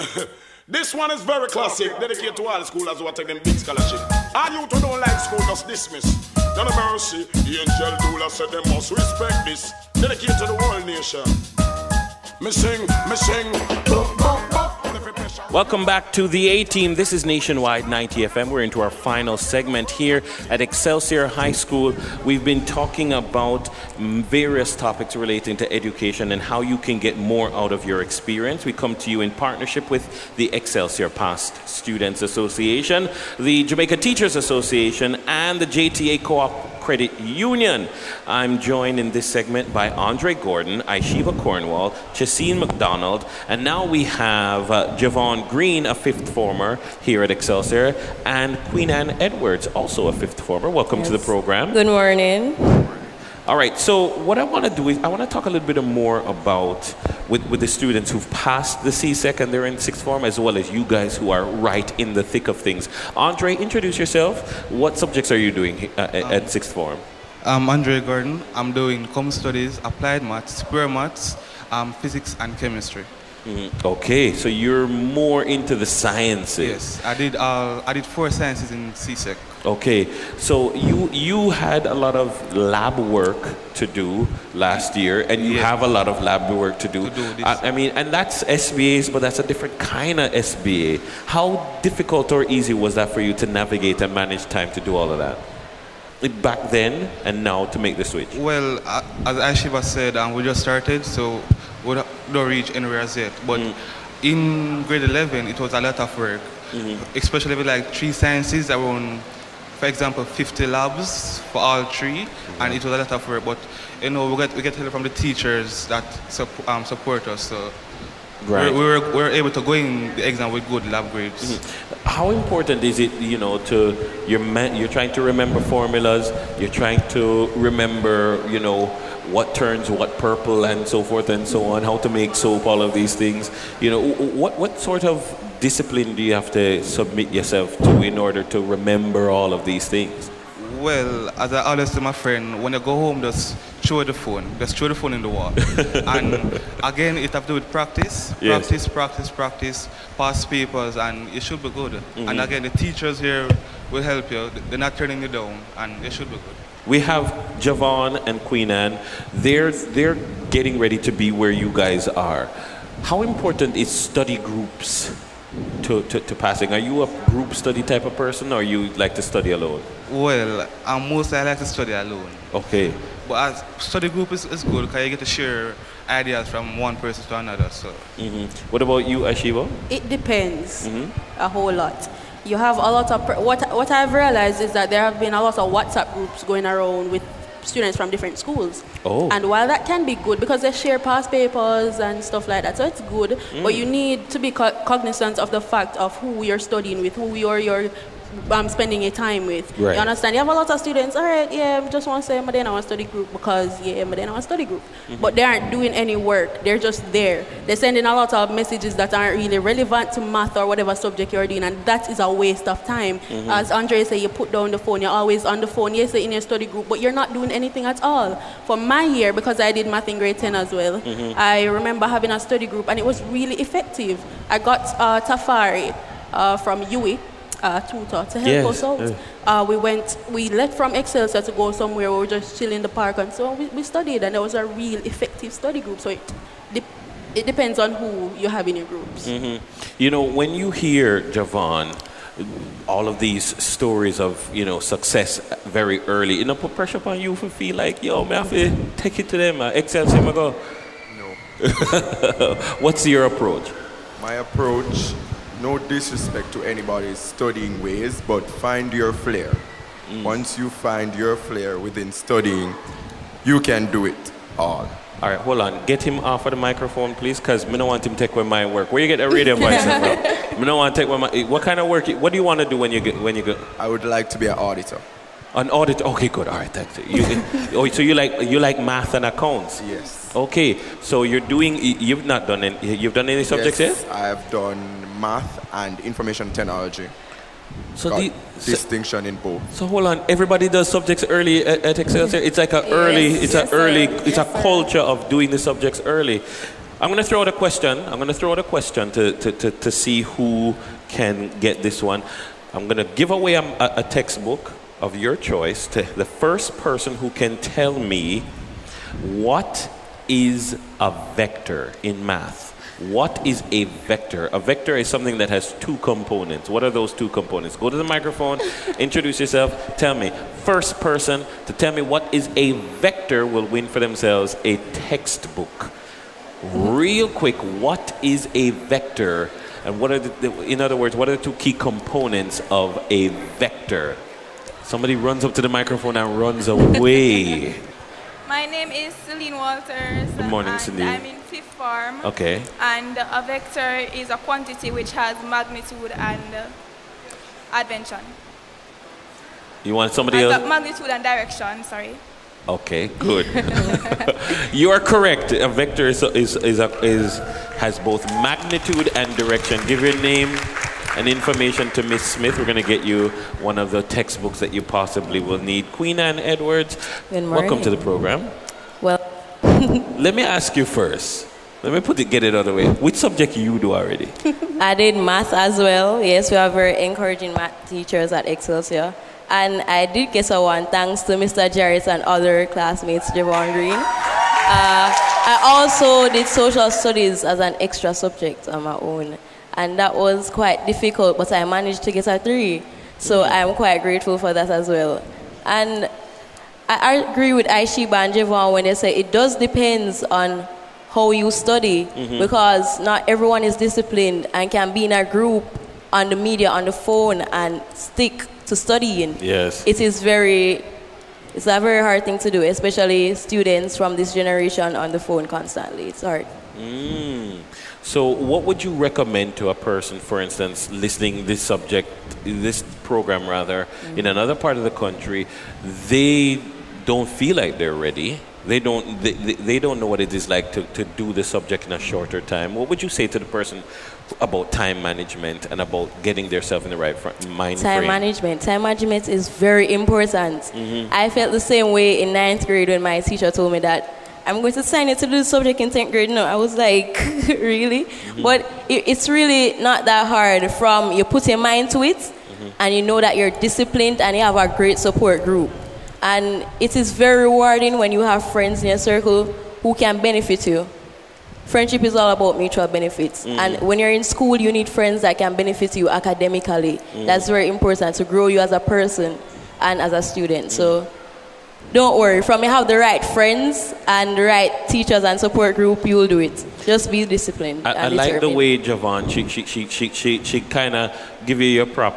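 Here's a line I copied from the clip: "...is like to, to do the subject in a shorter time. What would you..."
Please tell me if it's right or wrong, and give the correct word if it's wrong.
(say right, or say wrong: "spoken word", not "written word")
right.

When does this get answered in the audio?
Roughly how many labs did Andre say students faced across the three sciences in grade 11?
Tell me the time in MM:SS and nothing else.
01:50.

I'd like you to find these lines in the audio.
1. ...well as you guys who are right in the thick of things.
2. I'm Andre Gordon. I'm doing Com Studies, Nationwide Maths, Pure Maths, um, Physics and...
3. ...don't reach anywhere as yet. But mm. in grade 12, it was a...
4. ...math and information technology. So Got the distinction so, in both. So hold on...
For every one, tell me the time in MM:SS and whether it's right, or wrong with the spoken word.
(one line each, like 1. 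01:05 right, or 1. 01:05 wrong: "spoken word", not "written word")
1. 01:00 right
2. 01:07 wrong: "Applied", not "Nationwide"
3. 01:42 wrong: "11", not "12"
4. 04:45 right.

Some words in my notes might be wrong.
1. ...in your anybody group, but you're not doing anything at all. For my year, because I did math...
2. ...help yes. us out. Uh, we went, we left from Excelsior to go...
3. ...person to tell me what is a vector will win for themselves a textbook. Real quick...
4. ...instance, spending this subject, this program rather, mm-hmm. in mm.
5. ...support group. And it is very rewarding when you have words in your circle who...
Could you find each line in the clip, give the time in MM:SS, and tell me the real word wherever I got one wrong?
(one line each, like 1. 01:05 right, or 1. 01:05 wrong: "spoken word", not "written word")
1. 03:36 wrong: "study", not "anybody"
2. 03:48 right
3. 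05:20 right
4. 07:00 wrong: "listening", not "spending"
5. 07:34 wrong: "friends", not "words".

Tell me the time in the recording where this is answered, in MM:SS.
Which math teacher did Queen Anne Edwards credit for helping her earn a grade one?
06:21.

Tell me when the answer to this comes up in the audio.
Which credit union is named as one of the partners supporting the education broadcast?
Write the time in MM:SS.
00:35.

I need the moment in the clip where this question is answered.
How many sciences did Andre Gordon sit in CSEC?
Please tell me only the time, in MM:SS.
01:18.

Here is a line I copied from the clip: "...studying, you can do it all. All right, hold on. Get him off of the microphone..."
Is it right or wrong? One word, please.
right.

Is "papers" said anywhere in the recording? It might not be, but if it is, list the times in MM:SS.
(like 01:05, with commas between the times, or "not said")
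02:30, 03:11.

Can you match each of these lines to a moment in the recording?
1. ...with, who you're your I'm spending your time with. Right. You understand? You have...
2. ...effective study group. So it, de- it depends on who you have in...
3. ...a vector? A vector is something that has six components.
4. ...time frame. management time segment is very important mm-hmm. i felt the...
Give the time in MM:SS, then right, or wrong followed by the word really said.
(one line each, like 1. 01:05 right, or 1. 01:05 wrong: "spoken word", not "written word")
1. 03:17 right
2. 03:55 right
3. 05:13 wrong: "two", not "six"
4. 07:17 wrong: "management", not "segment".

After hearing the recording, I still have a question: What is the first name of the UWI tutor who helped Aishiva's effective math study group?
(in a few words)
Tafari.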